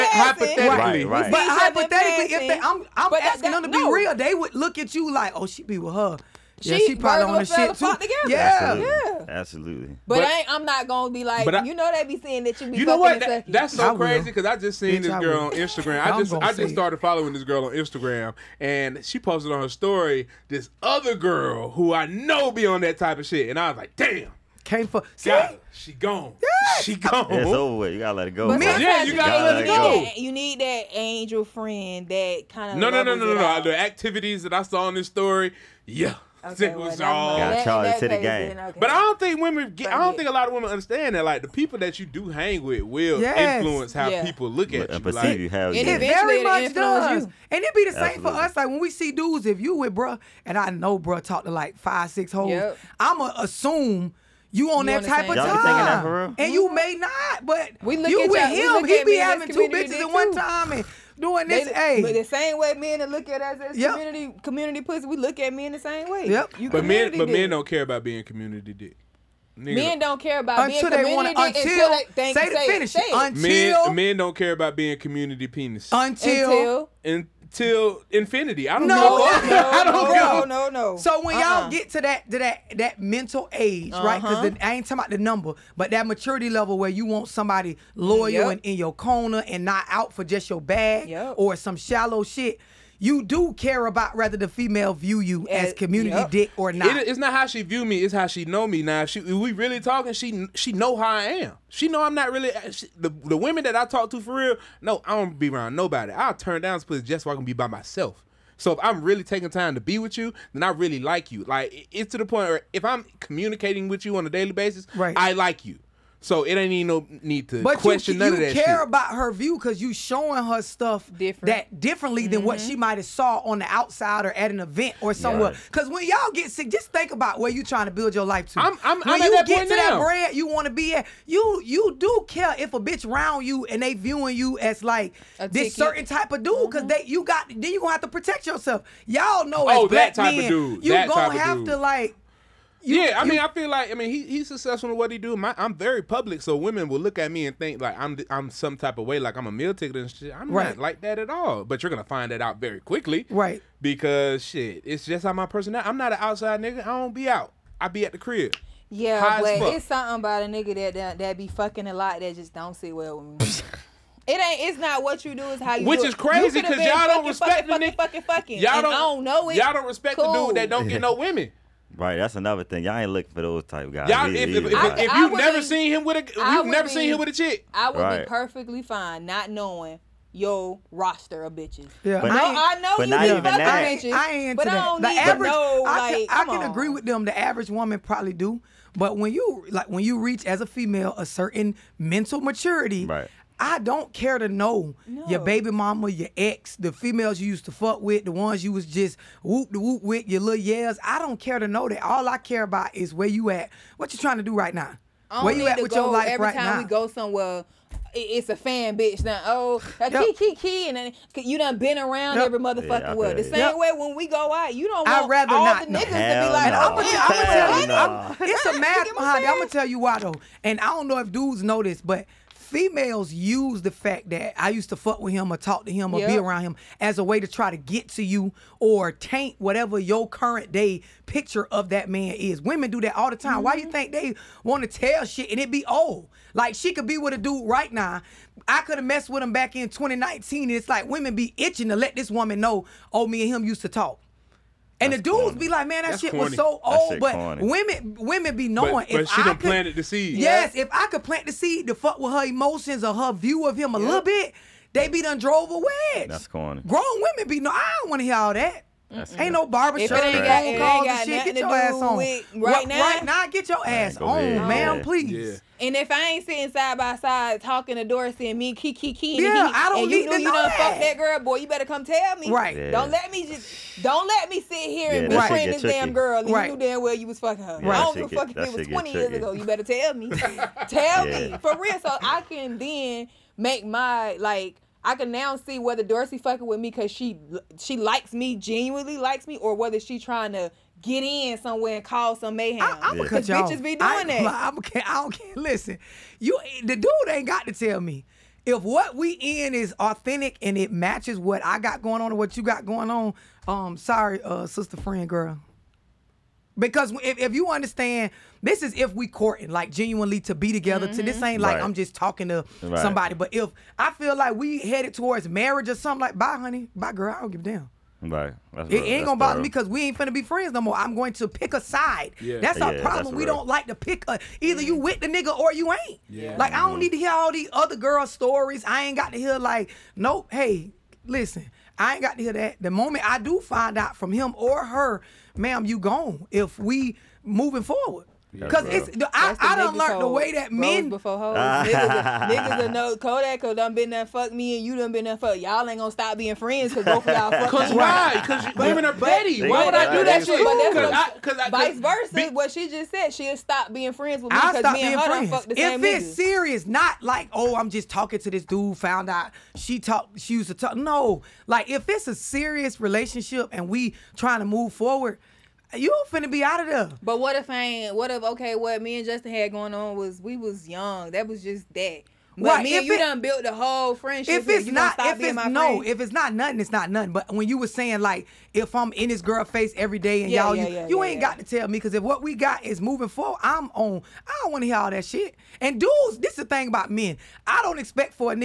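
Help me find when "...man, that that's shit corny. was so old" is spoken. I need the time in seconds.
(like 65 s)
245 s.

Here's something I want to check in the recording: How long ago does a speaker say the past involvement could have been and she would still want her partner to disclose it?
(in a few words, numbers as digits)
20 years ago.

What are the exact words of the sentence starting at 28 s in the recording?
But yeah, you gotta, gotta let, it go.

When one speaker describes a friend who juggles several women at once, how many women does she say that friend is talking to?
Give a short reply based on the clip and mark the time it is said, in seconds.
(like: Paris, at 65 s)
5 or 6, at 51 s.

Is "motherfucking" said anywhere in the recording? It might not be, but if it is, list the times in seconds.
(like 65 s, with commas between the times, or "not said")
212 s.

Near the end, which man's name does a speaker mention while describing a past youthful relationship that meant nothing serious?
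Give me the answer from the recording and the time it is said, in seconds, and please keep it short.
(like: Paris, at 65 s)
Justin, at 369 s.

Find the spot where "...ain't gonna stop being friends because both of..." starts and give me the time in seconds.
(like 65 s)
345 s.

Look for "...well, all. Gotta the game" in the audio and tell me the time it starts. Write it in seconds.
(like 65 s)
36 s.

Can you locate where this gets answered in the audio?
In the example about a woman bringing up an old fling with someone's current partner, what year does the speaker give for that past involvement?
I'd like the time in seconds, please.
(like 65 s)
239 s.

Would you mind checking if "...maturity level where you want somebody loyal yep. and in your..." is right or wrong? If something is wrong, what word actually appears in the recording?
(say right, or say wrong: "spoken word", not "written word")
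right.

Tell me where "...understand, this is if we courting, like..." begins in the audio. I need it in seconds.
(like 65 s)
307 s.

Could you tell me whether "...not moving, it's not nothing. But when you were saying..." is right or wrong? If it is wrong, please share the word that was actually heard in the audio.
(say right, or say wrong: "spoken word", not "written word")
wrong: "nothing", not "moving".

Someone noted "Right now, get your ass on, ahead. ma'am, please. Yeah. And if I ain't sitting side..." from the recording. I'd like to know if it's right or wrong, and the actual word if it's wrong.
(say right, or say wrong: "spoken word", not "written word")
right.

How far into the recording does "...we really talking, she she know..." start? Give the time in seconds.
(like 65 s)
99 s.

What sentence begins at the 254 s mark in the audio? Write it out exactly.
little bit, they be done drove a wedge.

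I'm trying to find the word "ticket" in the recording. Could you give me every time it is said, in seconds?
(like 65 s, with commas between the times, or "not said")
135 s, 149 s.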